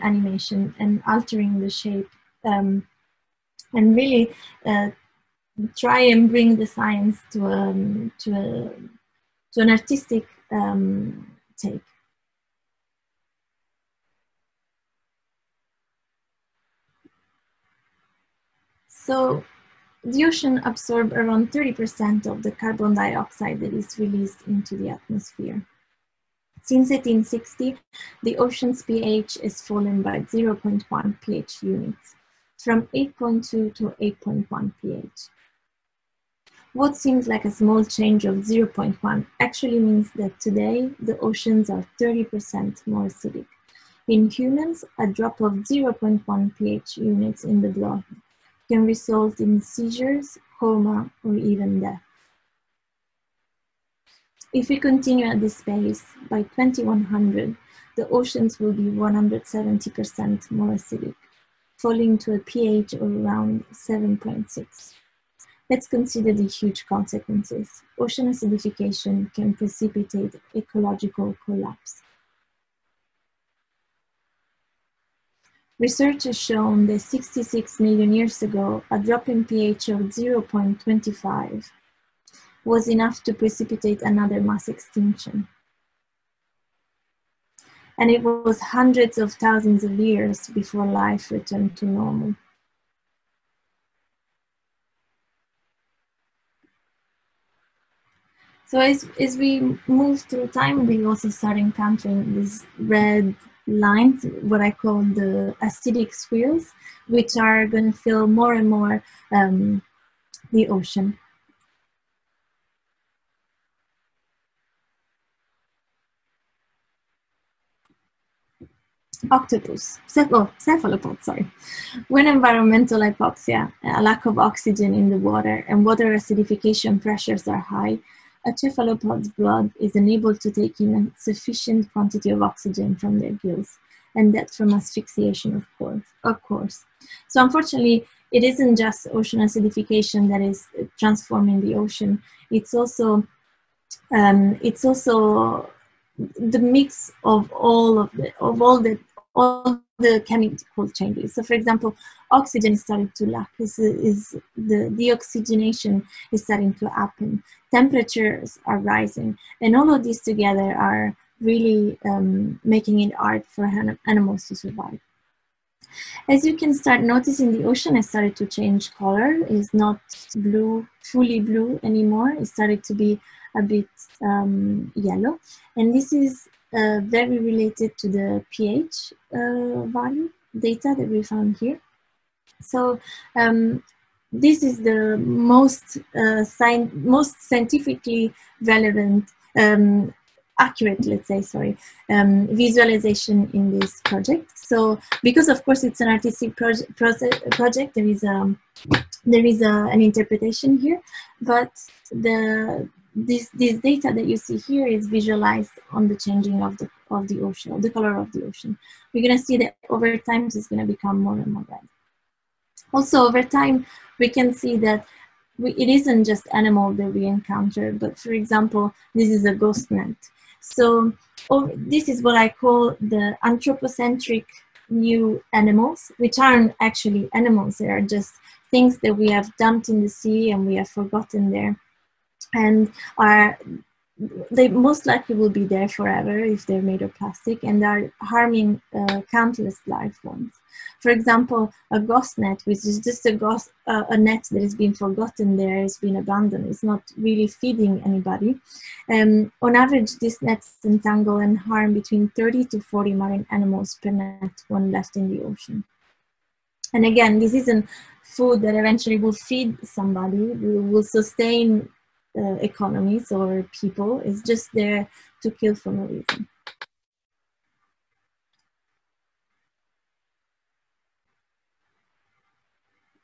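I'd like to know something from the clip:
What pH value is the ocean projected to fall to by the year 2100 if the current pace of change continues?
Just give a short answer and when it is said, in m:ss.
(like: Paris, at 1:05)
7.6, at 1:03.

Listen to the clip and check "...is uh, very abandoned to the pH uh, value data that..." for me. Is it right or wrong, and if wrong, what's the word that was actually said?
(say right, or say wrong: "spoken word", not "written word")
wrong: "related", not "abandoned".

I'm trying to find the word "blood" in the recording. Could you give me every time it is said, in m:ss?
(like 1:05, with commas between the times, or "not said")
0:47, 2:09.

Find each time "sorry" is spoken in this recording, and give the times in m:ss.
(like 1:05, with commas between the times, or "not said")
2:01, 3:11.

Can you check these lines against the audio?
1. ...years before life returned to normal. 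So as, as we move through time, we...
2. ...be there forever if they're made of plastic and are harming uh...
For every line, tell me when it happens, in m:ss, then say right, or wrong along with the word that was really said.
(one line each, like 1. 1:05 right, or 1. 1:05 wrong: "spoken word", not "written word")
1. 1:29 right
2. 3:55 right.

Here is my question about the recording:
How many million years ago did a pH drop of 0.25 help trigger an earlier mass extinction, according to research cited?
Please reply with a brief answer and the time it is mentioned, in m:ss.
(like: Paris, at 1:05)
66 million, at 1:16.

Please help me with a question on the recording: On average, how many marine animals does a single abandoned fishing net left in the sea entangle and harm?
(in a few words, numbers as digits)
30 to 40.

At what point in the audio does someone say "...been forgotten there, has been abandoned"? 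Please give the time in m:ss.
4:04.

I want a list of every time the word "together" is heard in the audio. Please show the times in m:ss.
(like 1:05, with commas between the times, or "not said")
2:40.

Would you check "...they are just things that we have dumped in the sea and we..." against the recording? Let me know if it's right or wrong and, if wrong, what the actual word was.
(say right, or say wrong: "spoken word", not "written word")
right.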